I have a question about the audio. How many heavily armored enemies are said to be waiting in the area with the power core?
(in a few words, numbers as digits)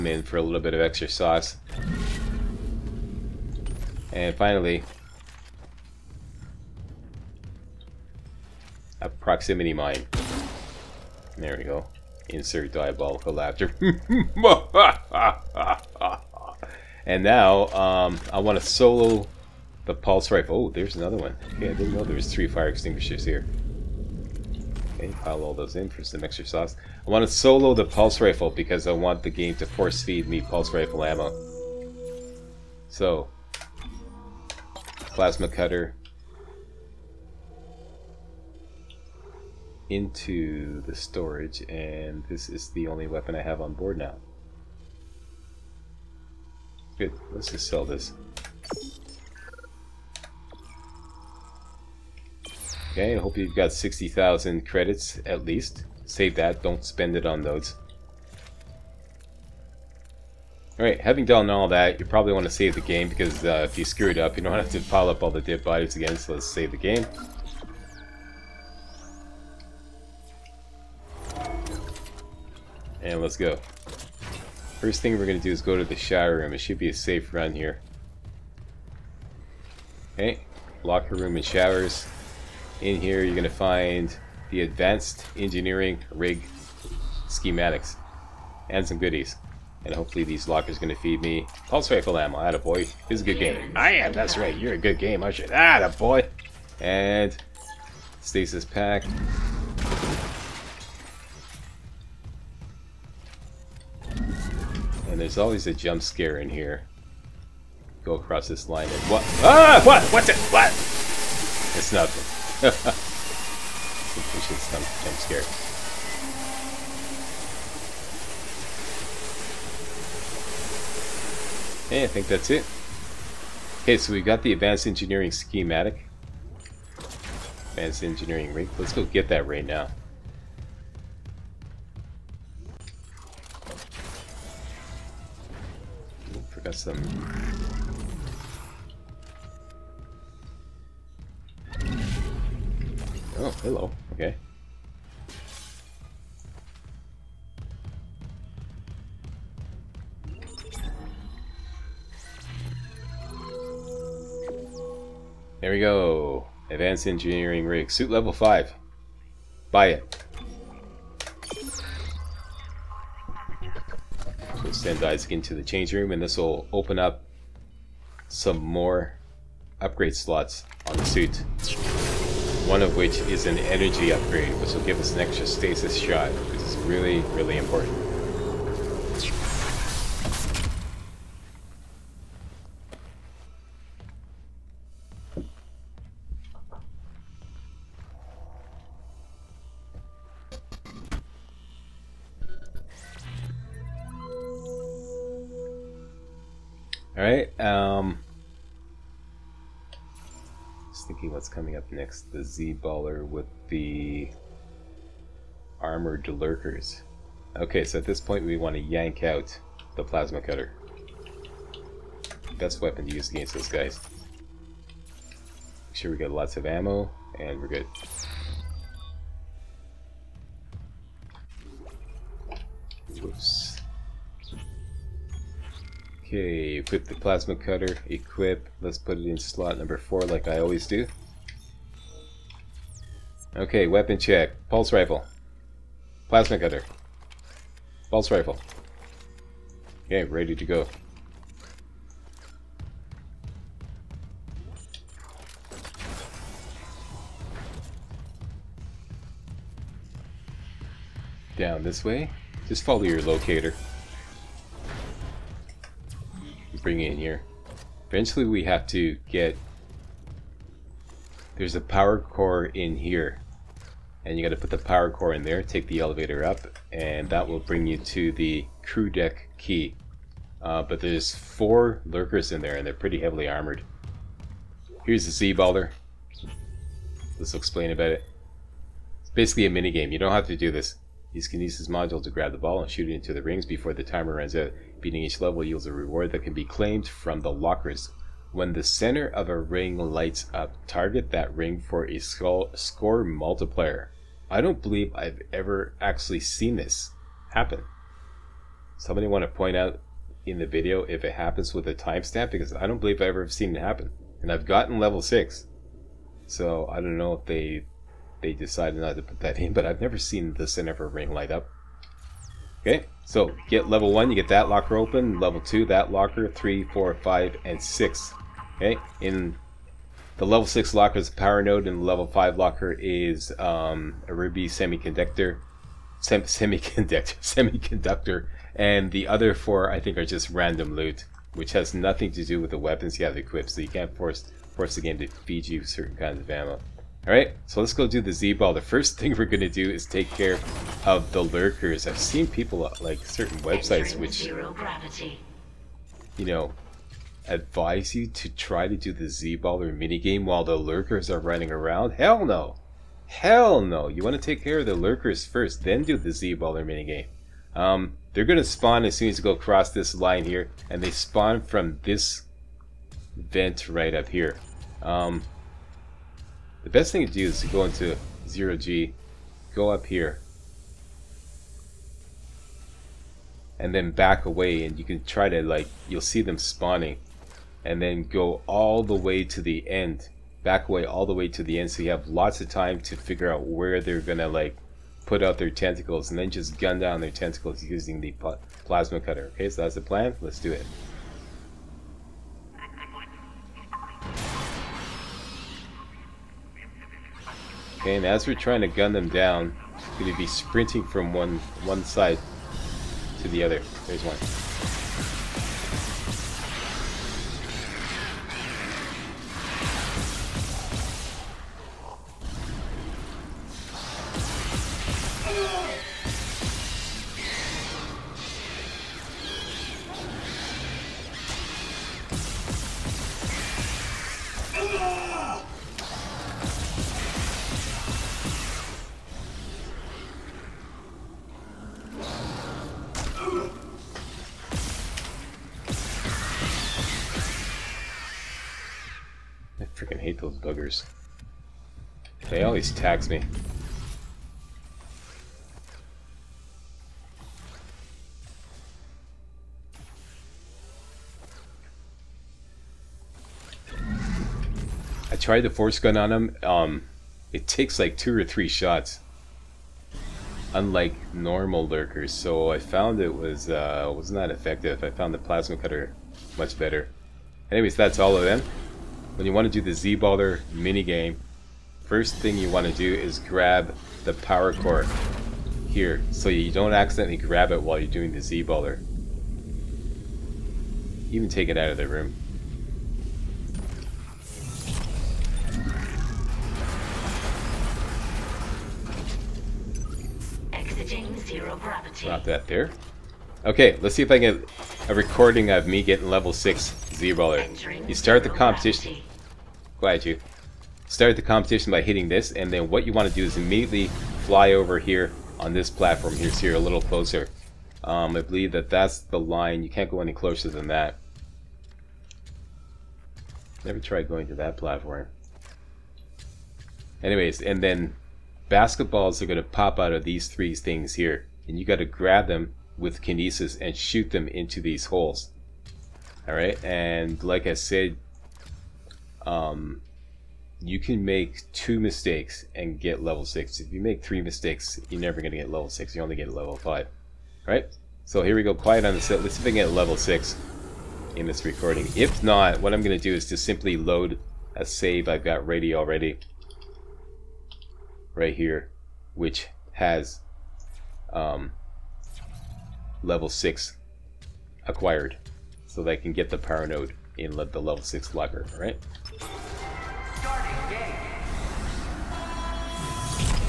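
4.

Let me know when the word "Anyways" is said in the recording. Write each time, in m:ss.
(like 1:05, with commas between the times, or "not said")
7:47, 8:37.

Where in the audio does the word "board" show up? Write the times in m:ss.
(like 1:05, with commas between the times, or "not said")
0:43.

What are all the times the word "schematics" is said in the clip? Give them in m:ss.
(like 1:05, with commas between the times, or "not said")
1:27, 2:05.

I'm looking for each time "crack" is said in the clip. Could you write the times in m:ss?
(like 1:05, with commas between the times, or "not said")
not said.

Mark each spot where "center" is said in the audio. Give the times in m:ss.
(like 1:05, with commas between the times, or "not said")
4:48, 5:10.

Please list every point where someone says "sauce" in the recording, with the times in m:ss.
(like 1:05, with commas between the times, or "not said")
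0:01, 0:26.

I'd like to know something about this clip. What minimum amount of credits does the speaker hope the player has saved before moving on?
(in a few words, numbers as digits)
60,000.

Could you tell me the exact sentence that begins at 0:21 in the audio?
Okay, I didn't know there was three fire extinguishers here.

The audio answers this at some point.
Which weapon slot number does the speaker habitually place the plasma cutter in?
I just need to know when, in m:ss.
3:49.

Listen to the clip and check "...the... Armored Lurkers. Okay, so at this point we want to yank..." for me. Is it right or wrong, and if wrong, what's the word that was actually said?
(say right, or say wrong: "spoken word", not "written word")
right.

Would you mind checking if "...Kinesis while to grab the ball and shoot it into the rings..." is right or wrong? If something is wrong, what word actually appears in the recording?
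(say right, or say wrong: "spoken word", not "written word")
wrong: "module", not "while".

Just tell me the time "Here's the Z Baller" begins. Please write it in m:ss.
4:35.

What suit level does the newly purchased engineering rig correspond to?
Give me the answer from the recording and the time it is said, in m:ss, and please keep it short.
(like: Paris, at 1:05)
5, at 2:37.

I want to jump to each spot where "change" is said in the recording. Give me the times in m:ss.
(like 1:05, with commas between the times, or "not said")
2:45.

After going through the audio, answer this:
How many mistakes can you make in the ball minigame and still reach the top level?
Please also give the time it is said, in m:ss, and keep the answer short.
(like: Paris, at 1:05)
2, at 8:51.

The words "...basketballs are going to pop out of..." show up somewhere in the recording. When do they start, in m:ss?
8:38.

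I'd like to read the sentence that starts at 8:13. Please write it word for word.
Okay, let's see if I can get a recording of me getting level 6 Z-Baller.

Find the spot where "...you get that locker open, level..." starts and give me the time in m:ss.
5:14.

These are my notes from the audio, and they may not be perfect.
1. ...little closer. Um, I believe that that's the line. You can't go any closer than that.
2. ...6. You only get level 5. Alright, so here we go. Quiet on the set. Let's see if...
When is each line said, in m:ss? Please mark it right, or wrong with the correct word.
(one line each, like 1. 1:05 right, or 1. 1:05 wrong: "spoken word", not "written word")
1. 8:26 right
2. 8:55 right.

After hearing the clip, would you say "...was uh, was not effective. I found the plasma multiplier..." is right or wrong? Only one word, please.
wrong.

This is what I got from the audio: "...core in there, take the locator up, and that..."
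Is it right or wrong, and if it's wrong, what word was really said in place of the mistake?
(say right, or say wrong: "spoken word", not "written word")
wrong: "elevator", not "locator".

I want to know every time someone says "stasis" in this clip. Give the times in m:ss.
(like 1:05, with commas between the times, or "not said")
1:38, 2:55.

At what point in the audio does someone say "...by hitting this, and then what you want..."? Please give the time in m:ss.
8:21.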